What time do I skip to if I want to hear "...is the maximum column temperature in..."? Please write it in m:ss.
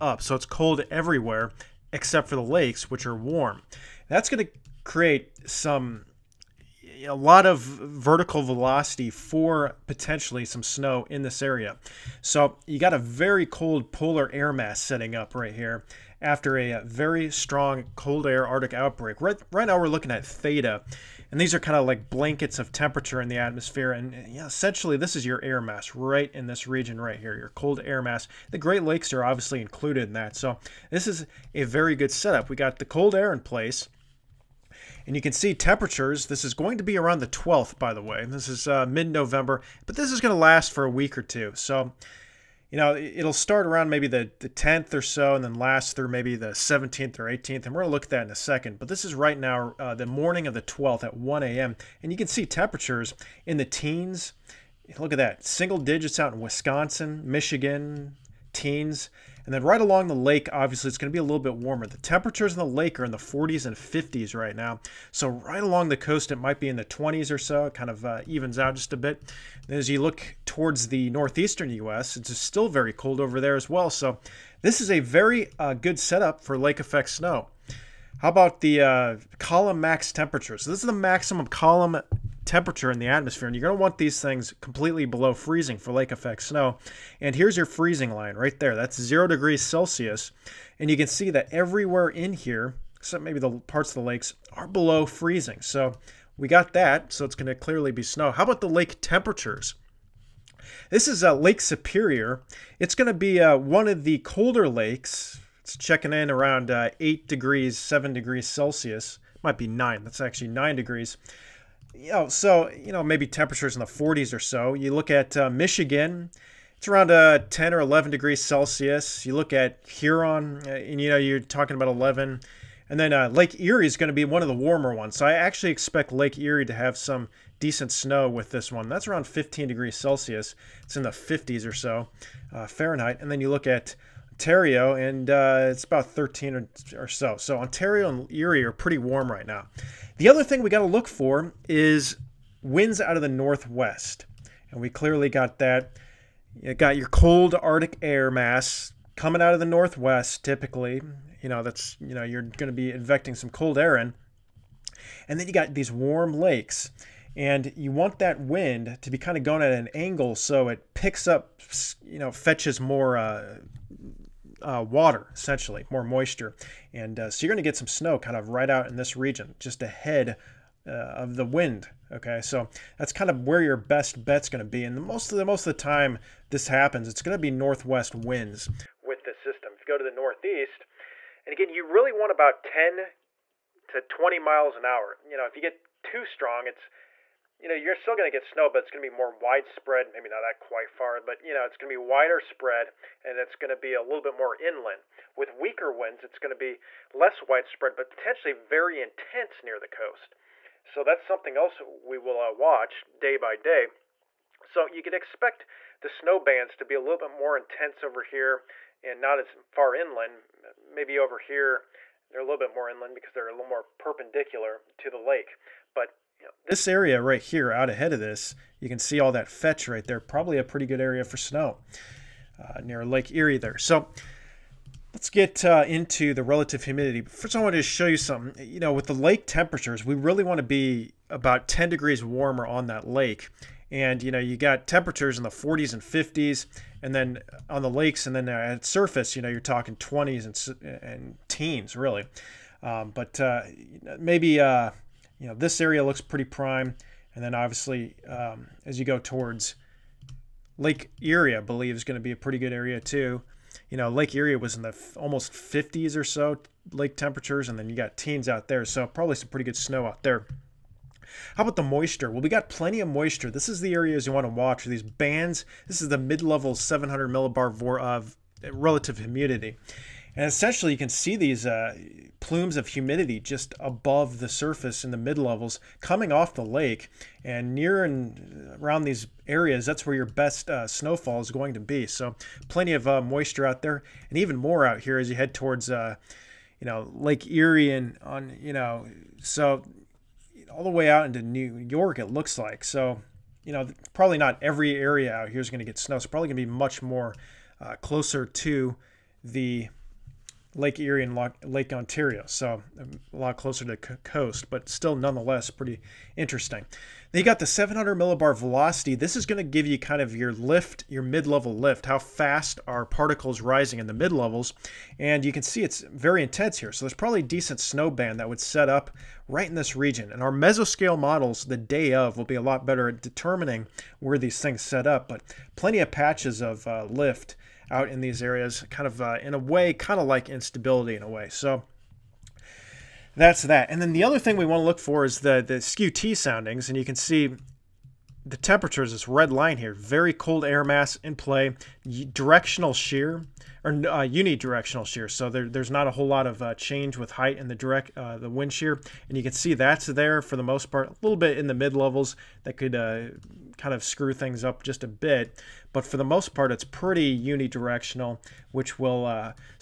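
1:20.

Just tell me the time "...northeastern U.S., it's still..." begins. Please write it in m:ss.
1:11.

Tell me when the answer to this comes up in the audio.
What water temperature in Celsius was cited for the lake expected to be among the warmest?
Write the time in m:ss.
2:09.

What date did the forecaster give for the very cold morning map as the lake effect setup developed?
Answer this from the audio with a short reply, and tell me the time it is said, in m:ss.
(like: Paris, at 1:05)
the 12th, at 0:49.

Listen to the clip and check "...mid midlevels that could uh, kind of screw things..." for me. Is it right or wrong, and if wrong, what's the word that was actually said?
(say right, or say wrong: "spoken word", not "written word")
wrong: "levels", not "midlevels".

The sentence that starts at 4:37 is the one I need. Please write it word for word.
And near and around these areas, that's where your best uh, snowfall is going to be.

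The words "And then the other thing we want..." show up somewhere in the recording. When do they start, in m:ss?
5:33.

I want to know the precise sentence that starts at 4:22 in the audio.
Well, we got plenty of moisture.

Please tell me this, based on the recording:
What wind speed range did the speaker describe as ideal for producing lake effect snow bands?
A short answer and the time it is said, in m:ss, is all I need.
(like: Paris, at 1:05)
10 to 20 miles an hour, at 3:02.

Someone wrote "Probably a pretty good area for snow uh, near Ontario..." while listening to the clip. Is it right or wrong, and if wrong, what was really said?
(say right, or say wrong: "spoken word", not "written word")
wrong: "Lake", not "Ontario".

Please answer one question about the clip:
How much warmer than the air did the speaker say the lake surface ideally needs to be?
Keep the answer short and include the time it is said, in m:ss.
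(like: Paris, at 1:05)
10 degrees, at 3:51.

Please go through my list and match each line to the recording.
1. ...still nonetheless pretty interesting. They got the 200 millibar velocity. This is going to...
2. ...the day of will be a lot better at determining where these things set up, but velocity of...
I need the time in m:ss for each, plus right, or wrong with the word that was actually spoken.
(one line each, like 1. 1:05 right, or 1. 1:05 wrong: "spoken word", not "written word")
1. 5:04 wrong: "700", not "200"
2. 5:21 wrong: "plenty", not "velocity".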